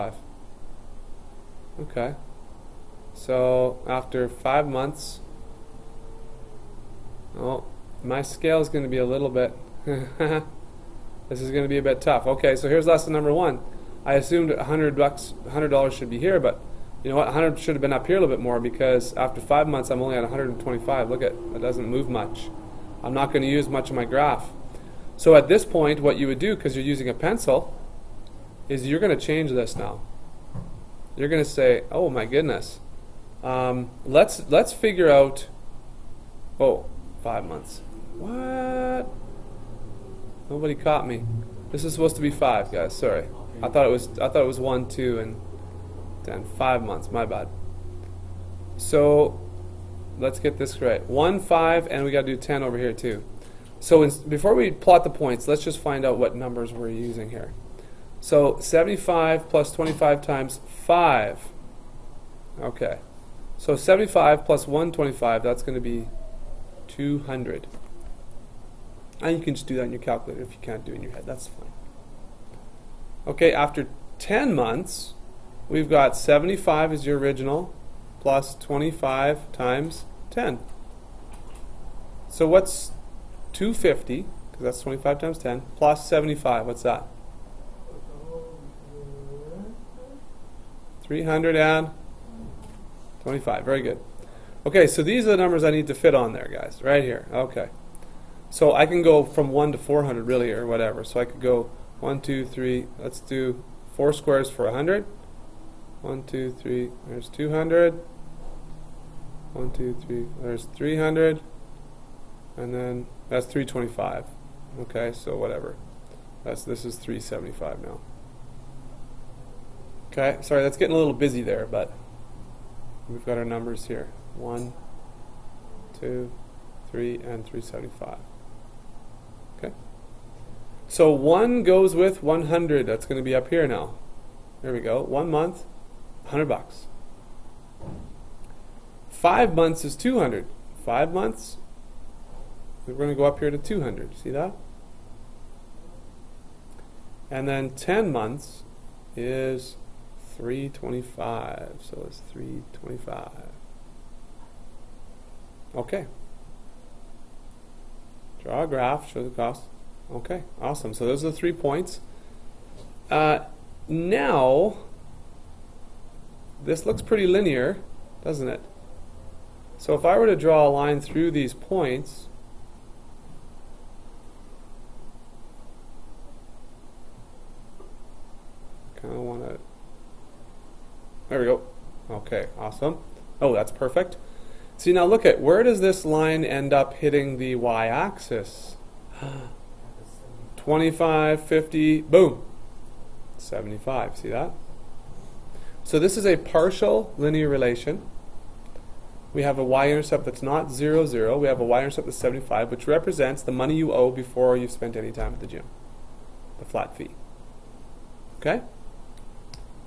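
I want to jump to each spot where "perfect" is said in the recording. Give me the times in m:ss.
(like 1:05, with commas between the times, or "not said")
3:03.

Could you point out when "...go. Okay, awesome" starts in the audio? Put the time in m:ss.
3:01.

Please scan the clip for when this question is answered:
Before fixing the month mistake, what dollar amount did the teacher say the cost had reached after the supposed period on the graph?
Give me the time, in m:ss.
0:19.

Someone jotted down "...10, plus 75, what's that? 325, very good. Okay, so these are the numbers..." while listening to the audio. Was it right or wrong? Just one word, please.
right.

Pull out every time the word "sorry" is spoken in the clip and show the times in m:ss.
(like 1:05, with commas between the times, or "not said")
0:42, 2:00.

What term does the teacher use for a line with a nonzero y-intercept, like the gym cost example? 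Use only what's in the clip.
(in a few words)
partial linear relation.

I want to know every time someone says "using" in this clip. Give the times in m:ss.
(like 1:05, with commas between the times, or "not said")
0:26, 0:56.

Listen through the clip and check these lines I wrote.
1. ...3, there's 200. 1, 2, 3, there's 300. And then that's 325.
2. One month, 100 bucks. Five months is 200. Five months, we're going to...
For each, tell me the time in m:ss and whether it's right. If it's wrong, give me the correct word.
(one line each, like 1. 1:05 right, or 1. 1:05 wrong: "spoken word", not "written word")
1. 1:46 right
2. 2:15 right.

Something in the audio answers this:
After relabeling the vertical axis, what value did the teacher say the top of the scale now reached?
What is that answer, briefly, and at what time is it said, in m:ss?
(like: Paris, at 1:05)
375, at 1:56.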